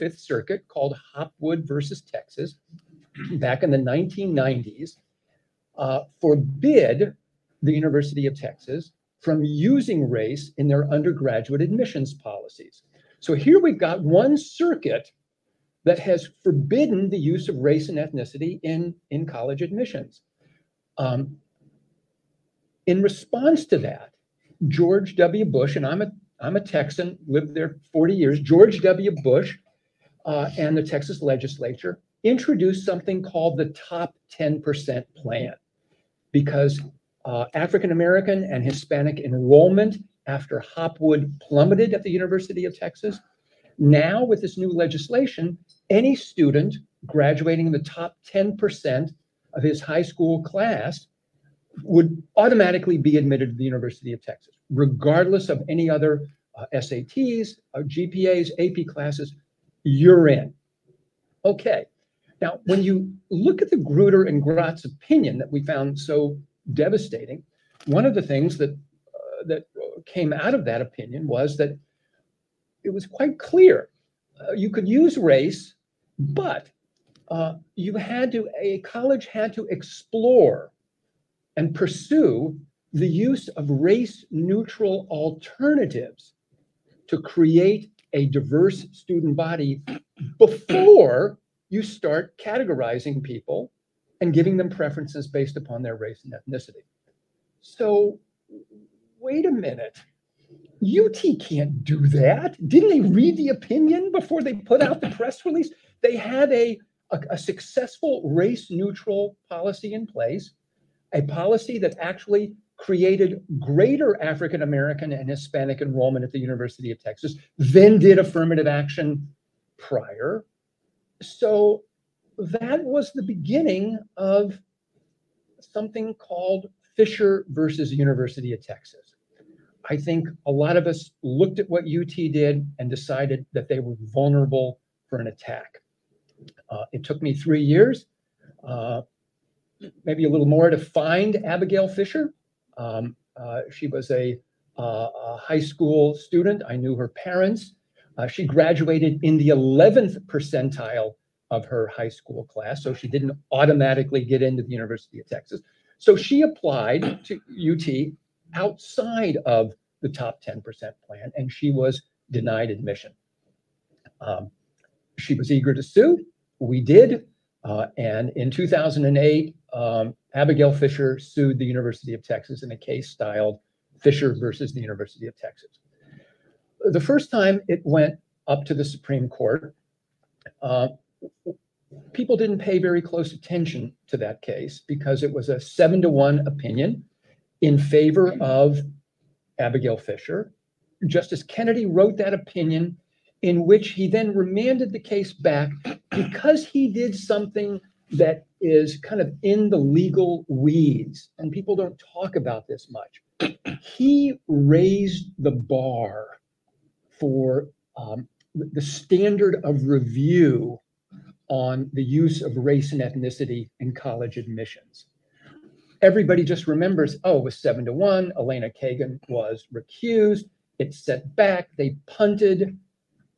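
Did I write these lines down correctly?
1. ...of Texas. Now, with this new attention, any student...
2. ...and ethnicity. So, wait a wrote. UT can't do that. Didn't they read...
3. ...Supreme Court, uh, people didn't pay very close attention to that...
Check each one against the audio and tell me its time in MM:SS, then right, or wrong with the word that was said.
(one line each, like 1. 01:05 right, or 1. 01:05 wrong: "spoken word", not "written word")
1. 00:42 wrong: "legislation", not "attention"
2. 01:36 wrong: "minute", not "wrote"
3. 02:58 right.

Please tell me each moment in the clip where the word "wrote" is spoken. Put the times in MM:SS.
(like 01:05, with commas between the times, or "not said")
03:11.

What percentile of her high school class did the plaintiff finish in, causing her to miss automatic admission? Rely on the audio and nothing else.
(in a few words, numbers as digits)
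11th percentile.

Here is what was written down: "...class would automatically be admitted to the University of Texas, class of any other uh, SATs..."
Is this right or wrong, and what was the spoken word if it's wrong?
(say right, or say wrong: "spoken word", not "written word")
wrong: "regardless", not "class".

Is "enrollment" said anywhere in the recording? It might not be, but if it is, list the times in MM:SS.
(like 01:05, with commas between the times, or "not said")
00:39, 01:55.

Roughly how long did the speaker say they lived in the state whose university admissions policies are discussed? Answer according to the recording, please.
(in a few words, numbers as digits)
40 years.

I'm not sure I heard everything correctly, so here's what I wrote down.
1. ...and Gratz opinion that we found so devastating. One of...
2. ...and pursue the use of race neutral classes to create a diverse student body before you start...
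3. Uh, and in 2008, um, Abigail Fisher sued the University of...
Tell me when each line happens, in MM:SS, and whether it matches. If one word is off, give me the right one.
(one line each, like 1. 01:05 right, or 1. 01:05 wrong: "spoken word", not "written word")
1. 01:04 right
2. 01:21 wrong: "alternatives", not "classes"
3. 02:47 right.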